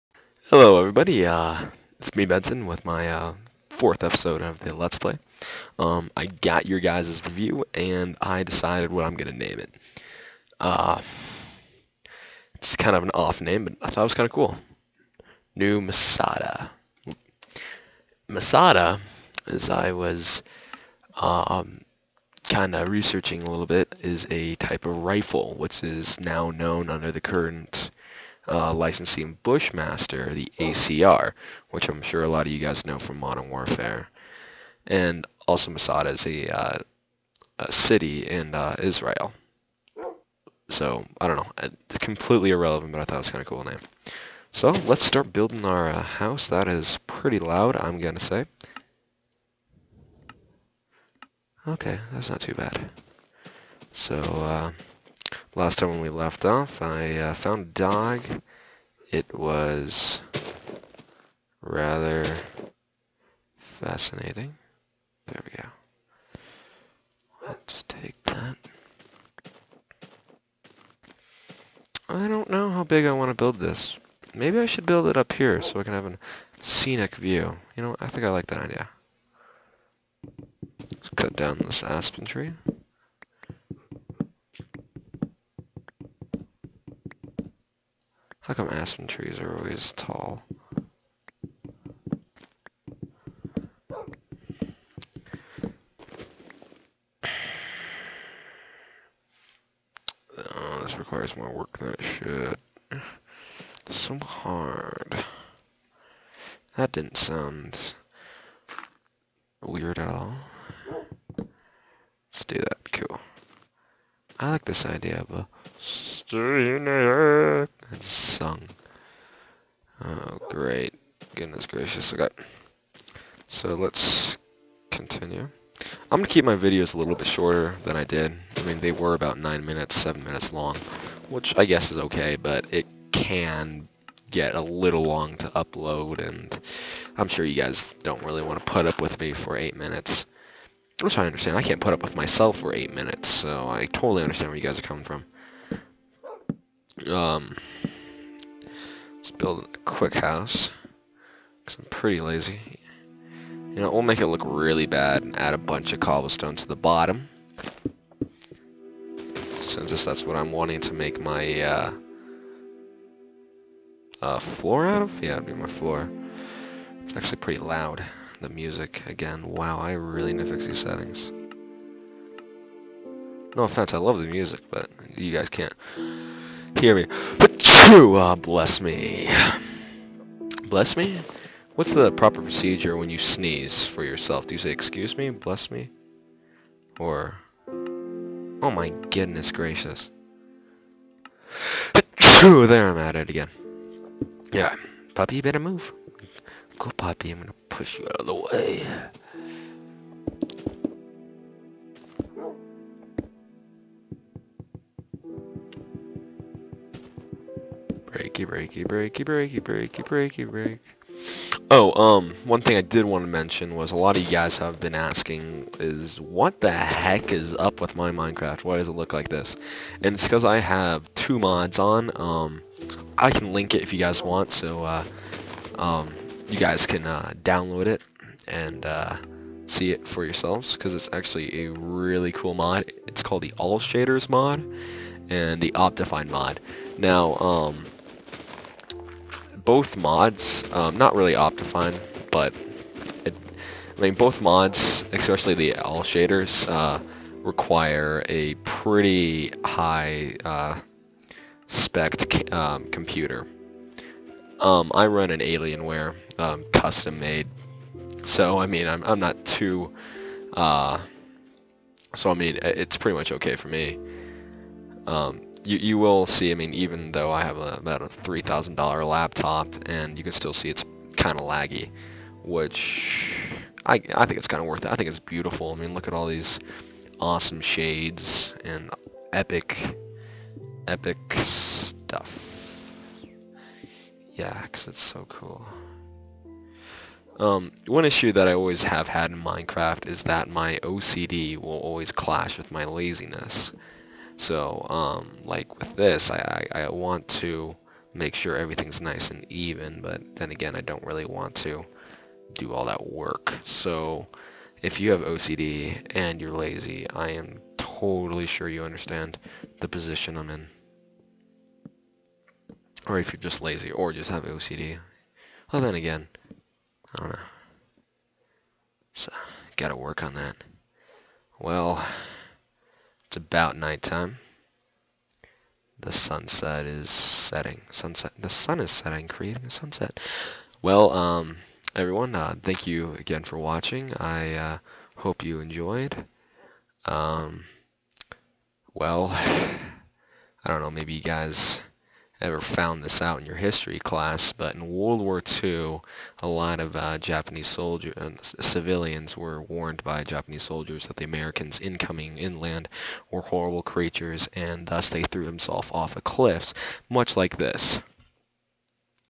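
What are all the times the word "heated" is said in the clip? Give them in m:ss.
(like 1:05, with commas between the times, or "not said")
not said.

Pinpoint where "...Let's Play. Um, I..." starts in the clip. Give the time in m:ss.
0:04.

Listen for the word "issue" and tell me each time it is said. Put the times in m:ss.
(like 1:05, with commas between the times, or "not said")
4:48.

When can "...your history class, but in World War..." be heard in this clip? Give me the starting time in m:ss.
5:43.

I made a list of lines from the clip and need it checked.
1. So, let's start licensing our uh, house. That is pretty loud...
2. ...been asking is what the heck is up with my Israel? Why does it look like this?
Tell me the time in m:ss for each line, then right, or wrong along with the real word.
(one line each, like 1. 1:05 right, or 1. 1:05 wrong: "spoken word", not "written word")
1. 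0:44 wrong: "building", not "licensing"
2. 3:34 wrong: "Minecraft", not "Israel".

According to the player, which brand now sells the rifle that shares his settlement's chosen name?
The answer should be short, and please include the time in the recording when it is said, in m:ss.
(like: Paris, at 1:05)
Bushmaster, at 0:29.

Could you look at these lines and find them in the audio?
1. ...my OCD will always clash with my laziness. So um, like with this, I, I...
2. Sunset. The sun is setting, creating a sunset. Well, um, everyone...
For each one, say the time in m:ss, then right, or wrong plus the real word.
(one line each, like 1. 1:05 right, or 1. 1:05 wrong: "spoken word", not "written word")
1. 4:50 right
2. 5:27 right.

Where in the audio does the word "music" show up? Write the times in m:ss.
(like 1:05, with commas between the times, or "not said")
2:48, 2:54.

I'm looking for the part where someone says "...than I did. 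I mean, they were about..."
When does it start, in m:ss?
2:07.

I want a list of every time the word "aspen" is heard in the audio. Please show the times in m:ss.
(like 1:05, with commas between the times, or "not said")
1:21, 1:28.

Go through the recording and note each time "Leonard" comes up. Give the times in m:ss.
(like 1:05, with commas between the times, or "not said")
not said.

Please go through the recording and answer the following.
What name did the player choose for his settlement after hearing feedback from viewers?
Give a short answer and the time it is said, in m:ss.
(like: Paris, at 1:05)
New Masada, at 0:15.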